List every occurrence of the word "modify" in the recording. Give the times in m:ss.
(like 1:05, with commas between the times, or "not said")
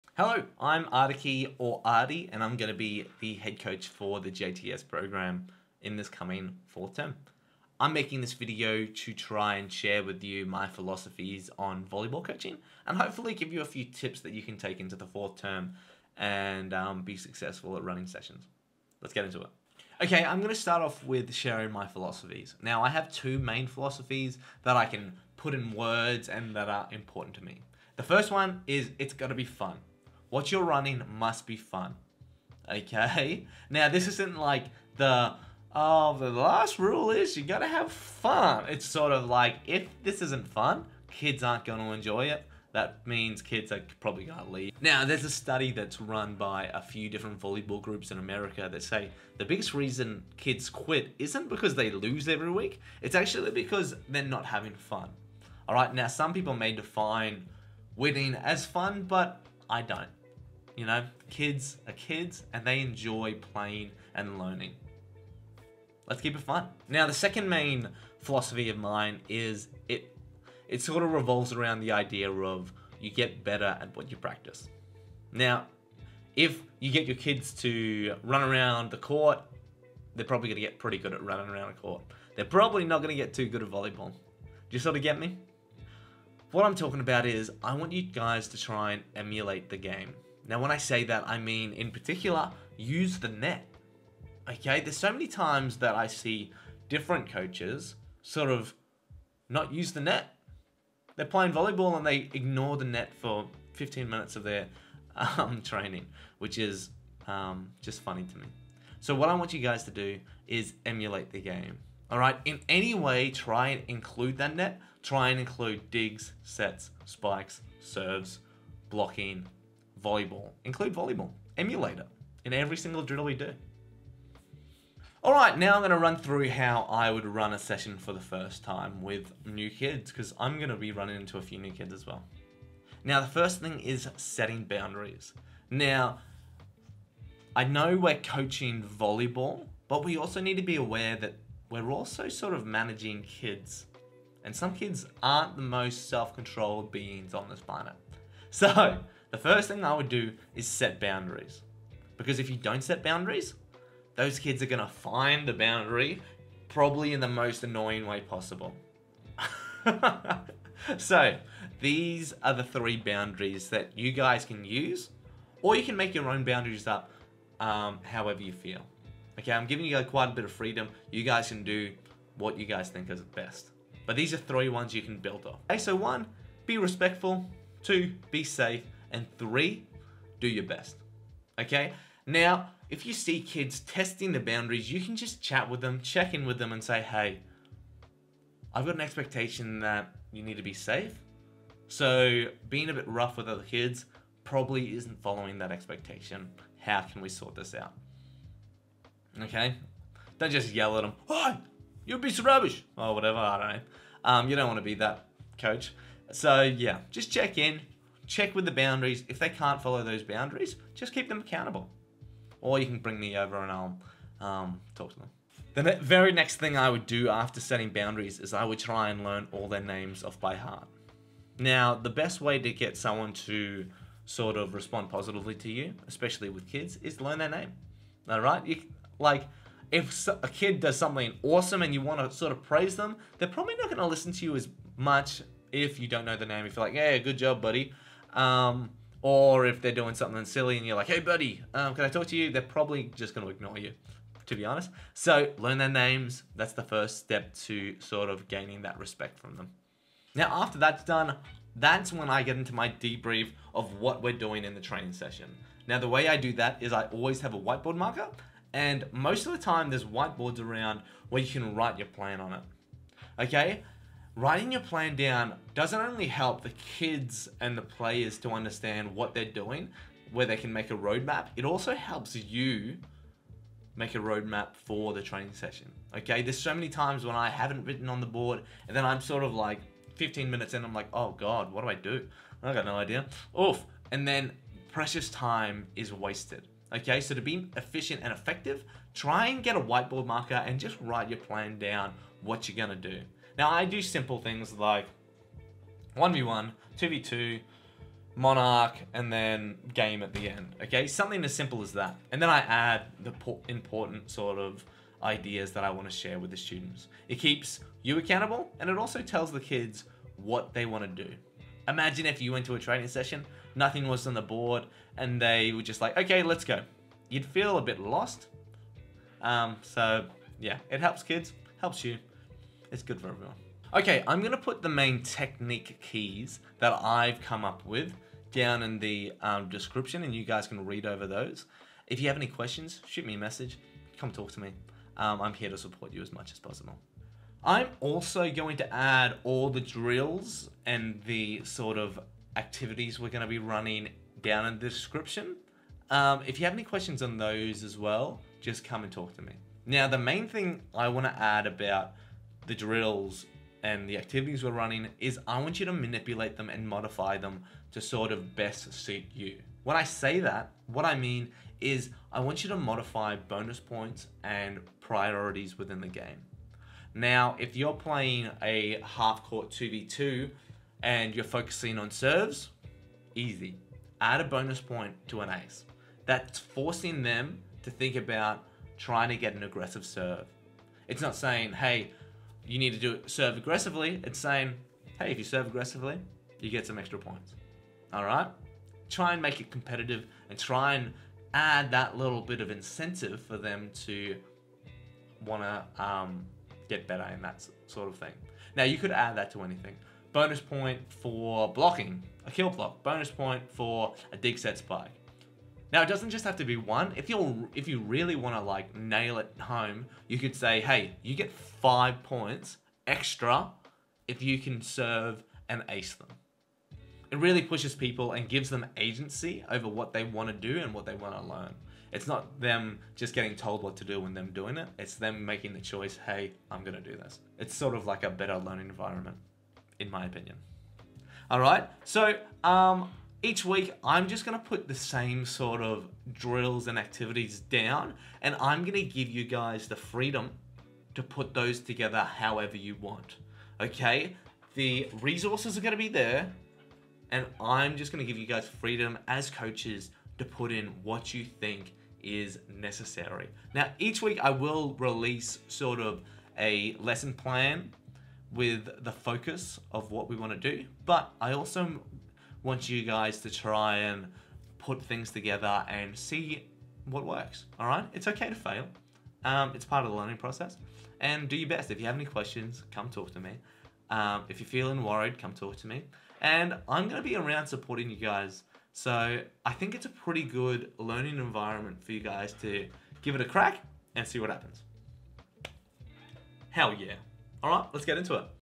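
5:56, 6:02.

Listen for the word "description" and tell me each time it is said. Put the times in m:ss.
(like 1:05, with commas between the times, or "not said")
5:29, 5:44.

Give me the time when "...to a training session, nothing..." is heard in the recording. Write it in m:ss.
5:12.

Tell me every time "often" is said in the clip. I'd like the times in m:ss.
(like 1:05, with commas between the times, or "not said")
not said.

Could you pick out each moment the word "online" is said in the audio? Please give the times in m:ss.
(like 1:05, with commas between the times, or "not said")
not said.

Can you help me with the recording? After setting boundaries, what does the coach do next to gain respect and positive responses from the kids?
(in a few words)
Learn their names.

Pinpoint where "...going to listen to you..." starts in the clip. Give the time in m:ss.
3:53.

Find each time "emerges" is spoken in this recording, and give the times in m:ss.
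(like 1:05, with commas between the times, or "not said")
not said.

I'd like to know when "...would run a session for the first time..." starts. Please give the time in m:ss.
2:07.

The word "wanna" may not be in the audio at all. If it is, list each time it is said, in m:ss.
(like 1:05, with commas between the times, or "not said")
5:51.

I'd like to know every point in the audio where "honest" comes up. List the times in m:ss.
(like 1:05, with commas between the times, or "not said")
4:04.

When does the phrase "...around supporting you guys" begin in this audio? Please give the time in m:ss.
7:57.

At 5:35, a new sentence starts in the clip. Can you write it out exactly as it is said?
Um, I'm here to support you as much as possible.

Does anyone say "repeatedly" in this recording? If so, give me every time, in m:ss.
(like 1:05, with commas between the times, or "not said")
not said.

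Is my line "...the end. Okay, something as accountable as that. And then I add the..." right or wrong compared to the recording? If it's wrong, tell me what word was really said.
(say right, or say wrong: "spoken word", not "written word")
wrong: "simple", not "accountable".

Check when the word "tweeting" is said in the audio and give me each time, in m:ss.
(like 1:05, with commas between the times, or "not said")
not said.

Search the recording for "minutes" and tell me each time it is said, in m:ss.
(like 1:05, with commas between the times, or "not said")
1:44, 4:40.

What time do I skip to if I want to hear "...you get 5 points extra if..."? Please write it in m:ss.
6:51.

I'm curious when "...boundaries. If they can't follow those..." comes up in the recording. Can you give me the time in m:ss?
3:28.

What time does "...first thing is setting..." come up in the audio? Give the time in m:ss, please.
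2:13.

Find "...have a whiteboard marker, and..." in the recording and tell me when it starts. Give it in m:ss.
4:17.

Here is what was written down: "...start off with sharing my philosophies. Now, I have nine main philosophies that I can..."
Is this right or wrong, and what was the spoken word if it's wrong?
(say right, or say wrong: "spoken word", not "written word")
wrong: "two", not "nine".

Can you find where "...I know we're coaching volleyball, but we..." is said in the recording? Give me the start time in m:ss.
2:17.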